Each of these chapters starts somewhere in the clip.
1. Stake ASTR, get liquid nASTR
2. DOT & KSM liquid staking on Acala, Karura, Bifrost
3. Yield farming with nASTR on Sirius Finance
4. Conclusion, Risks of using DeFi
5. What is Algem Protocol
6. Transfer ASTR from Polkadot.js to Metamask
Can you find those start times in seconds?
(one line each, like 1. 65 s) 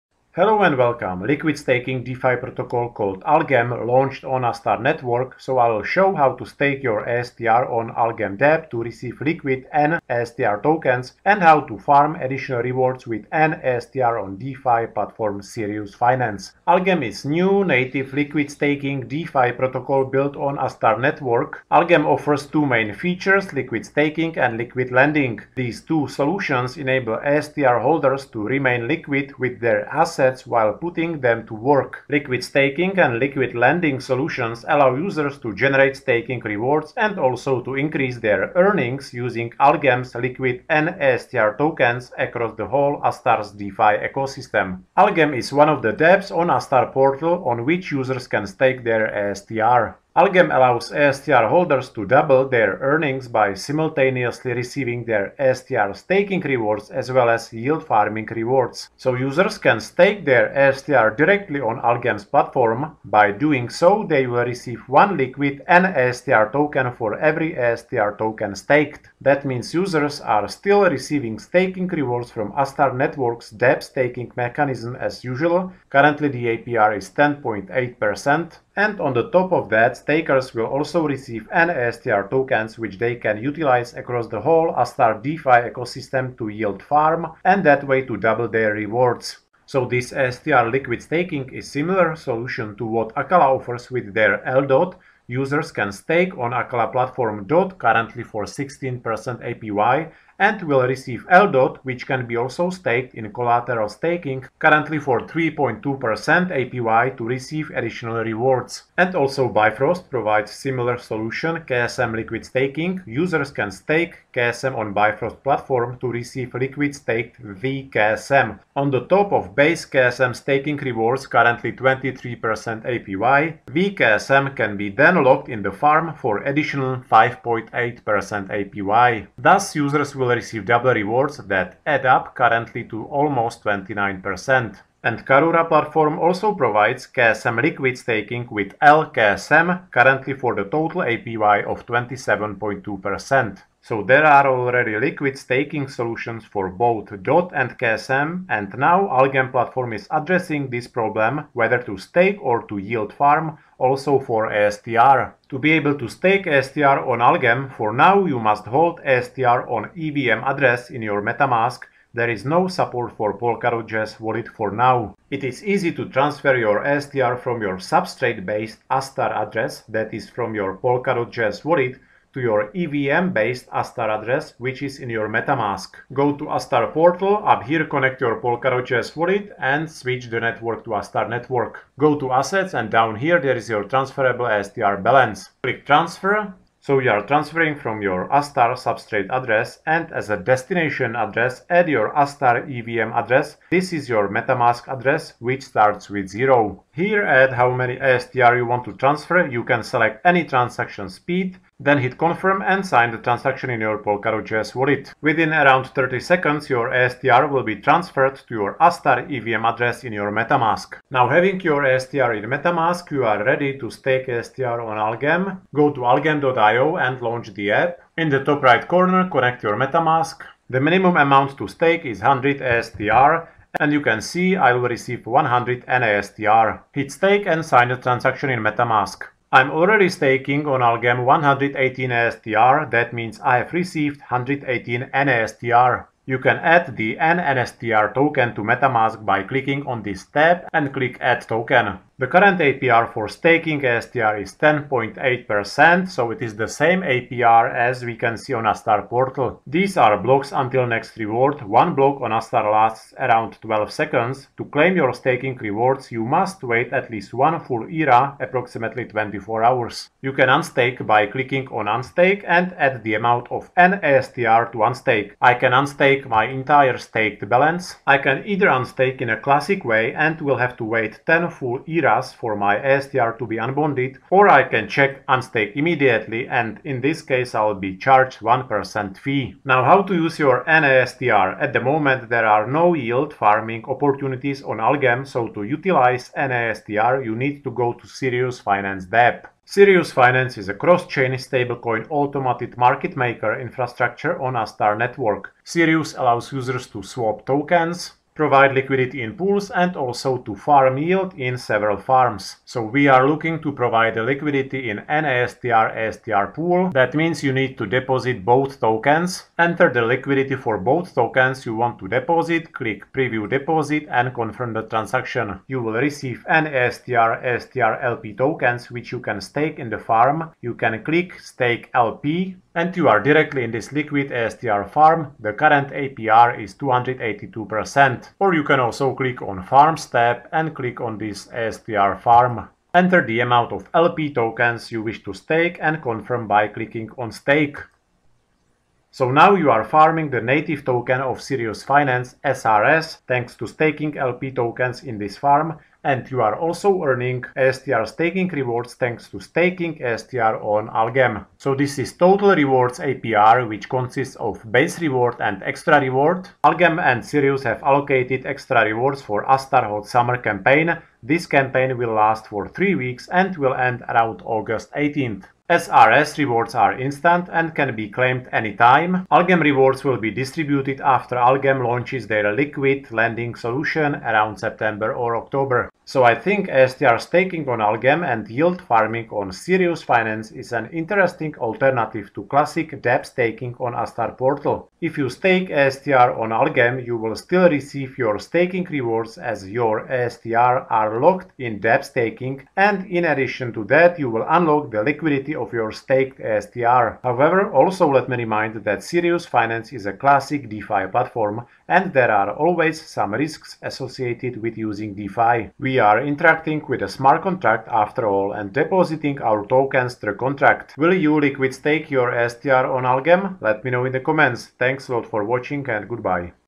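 1. 210 s
2. 89 s
3. 279 s
4. 376 s
5. 16 s
6. 155 s.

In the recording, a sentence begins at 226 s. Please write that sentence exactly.
Hit stake and sign the transaction in MetaMask.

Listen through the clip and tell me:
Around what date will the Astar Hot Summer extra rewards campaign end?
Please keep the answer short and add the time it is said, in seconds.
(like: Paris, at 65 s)
August 18th, at 364 s.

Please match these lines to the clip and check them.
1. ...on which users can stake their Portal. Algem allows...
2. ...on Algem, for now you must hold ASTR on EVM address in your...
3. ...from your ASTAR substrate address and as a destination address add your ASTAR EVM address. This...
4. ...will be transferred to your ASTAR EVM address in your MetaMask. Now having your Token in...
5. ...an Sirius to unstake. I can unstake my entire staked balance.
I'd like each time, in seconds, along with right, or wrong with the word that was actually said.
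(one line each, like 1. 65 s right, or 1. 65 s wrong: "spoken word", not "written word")
1. 47 s wrong: "STR", not "Portal"
2. 157 s right
3. 187 s right
4. 207 s wrong: "ASTR", not "Token"
5. 263 s wrong: "ASTR", not "Sirius".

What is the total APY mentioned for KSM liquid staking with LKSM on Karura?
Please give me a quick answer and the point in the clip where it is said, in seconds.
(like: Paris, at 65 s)
27.2%, at 141 s.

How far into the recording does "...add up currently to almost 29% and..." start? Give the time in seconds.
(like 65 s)
131 s.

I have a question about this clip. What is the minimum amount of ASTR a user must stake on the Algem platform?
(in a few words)
100 ASTR.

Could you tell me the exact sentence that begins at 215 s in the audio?
Go to algem.io and launch the app.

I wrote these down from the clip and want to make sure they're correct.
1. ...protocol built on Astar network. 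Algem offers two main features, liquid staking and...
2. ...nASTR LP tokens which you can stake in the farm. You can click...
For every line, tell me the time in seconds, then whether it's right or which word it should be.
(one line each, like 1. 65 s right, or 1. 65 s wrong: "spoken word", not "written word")
1. 19 s right
2. 316 s right.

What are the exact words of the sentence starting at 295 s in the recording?
Sirius allows users to swap tokens, provide liquidity in pools and also to farm yield in several farms.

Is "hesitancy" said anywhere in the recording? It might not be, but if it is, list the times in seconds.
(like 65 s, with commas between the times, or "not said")
not said.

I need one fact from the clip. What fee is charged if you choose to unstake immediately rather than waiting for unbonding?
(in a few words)
1%.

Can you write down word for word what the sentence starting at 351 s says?
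So this is total rewards APR which consists of base reward and extra reward.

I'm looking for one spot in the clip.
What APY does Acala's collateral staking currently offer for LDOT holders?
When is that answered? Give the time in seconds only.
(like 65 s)
105 s.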